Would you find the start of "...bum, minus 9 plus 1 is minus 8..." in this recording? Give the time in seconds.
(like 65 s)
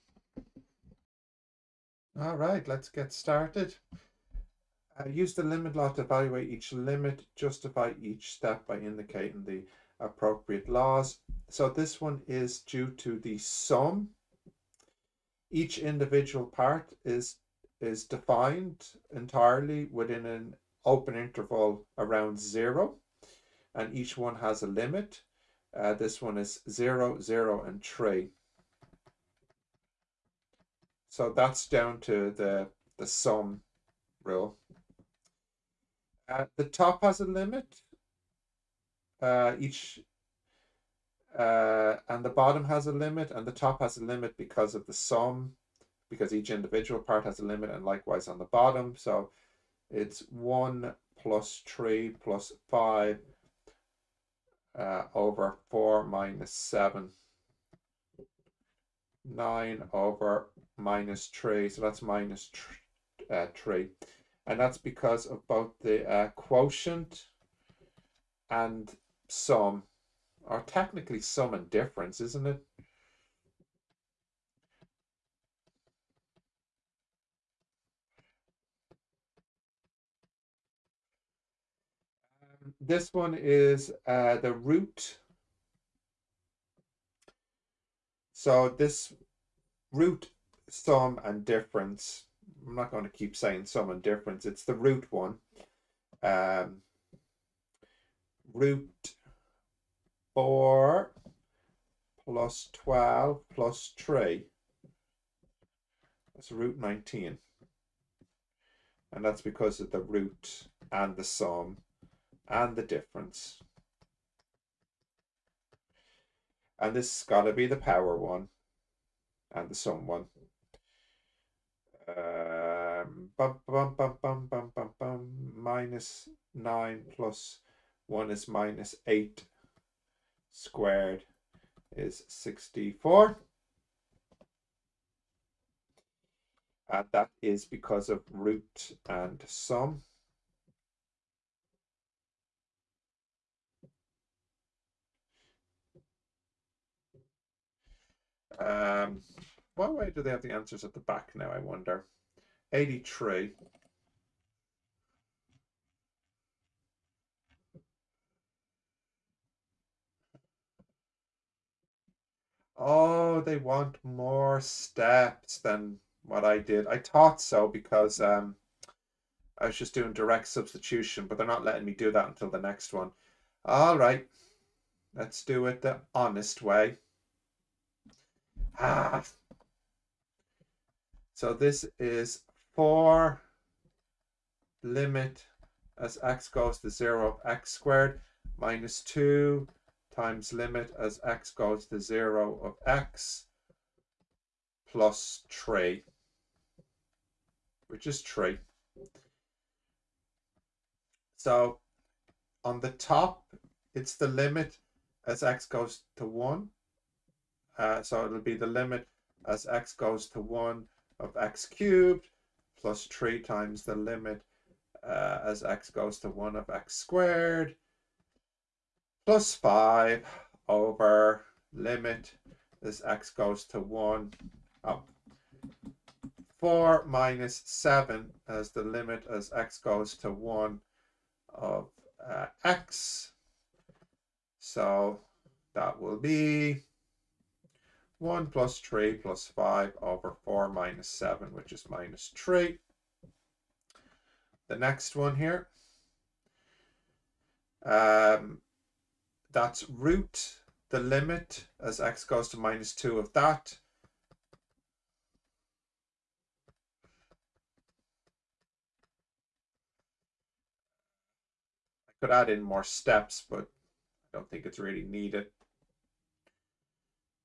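124 s.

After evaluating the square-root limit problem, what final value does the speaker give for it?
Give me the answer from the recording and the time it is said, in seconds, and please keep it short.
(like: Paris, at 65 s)
root 19, at 106 s.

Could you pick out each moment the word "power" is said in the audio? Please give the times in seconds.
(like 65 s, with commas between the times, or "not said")
117 s.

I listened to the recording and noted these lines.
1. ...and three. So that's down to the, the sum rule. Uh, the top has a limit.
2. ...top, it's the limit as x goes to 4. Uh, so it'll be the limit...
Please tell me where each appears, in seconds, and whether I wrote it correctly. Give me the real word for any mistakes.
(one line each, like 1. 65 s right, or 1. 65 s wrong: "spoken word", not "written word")
1. 27 s right
2. 202 s wrong: "1", not "4".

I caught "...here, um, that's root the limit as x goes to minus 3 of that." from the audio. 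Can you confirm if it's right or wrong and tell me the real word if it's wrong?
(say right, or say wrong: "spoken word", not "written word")
wrong: "2", not "3".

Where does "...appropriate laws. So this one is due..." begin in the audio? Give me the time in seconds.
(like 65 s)
9 s.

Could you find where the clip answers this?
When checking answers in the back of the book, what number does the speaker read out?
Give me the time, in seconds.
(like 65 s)
152 s.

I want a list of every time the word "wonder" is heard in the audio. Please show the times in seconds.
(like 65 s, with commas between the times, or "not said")
151 s.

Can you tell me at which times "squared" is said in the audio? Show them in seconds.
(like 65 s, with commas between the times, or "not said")
130 s, 187 s, 216 s.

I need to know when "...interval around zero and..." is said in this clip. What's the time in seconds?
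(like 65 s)
21 s.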